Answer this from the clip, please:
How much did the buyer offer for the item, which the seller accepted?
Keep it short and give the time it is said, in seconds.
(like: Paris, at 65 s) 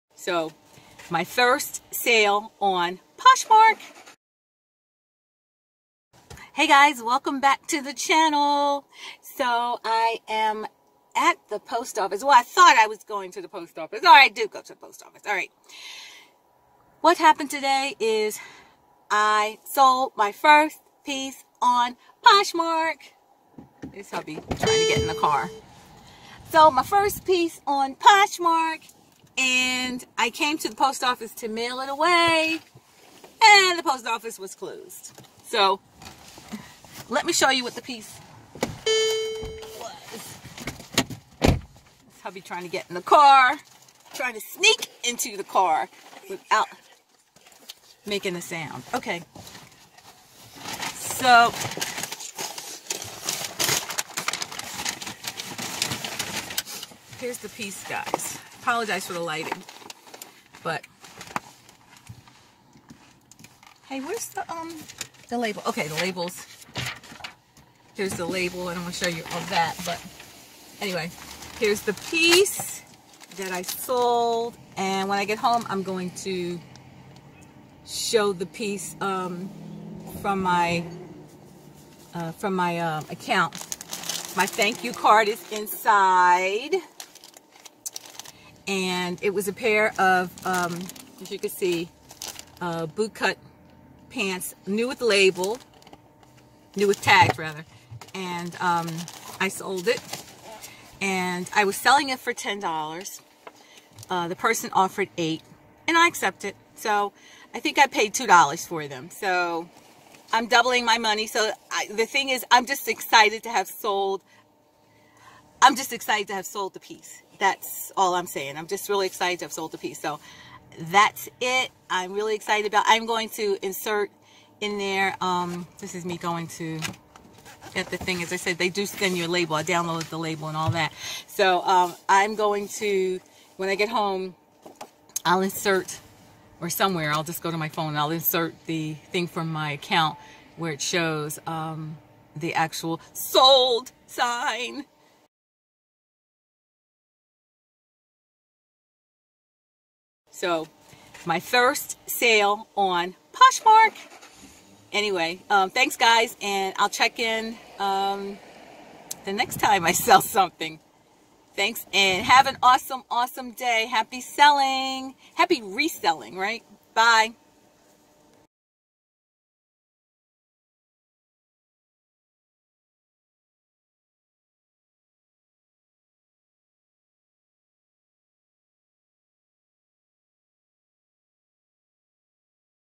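$8, at 105 s.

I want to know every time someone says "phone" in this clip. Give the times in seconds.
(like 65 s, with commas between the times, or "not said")
137 s.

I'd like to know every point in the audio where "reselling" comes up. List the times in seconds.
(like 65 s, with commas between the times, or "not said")
165 s.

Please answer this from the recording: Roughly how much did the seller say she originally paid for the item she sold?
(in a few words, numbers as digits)
$2.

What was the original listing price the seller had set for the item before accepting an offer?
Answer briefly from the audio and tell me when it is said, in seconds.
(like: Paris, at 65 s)
$10, at 102 s.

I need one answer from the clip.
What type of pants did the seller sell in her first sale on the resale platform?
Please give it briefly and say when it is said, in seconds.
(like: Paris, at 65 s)
Bootcut, at 92 s.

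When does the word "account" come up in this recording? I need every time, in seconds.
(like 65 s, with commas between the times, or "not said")
83 s, 139 s.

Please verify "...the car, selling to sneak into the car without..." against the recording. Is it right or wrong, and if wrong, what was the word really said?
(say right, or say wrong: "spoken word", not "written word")
wrong: "trying", not "selling".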